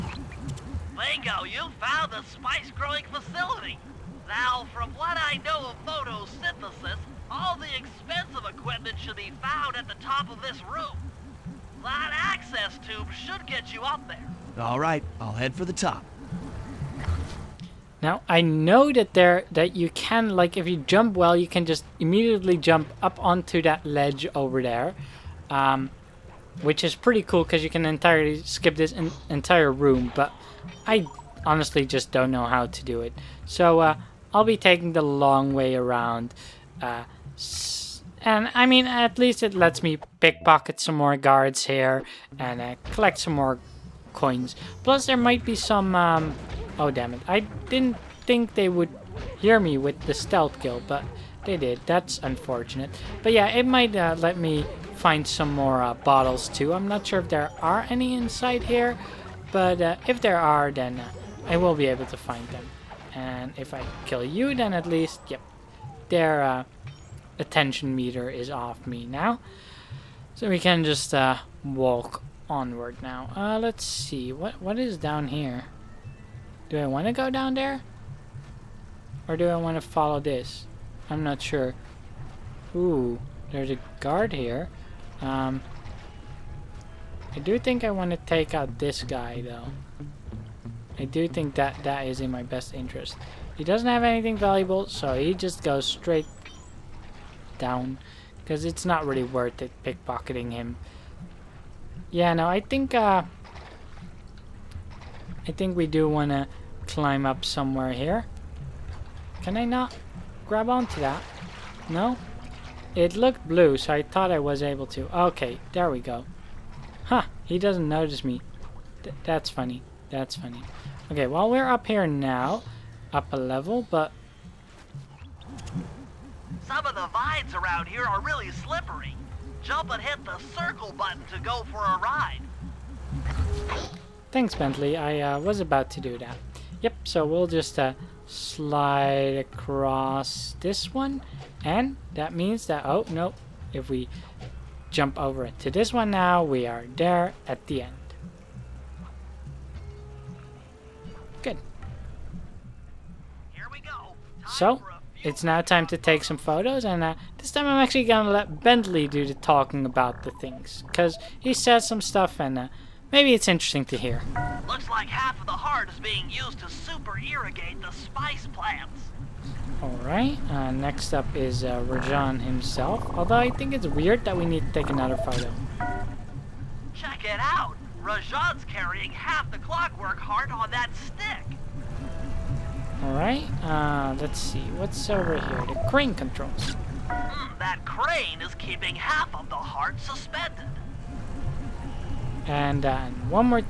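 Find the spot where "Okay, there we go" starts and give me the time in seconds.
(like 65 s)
115 s.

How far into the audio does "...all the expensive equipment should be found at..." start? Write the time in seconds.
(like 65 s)
7 s.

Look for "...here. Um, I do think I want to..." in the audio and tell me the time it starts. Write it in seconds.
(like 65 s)
84 s.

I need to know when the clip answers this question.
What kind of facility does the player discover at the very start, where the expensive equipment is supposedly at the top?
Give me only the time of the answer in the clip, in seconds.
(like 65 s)
2 s.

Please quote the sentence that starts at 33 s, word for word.
So, uh, I'll be taking the long way around.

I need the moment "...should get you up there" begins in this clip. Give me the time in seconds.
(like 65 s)
13 s.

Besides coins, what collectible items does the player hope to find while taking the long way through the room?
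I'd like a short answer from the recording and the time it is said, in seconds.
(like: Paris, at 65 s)
Bottles, at 55 s.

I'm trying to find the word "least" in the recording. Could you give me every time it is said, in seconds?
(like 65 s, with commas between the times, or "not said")
39 s, 64 s.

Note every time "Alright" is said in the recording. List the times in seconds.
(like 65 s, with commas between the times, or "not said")
169 s, 183 s.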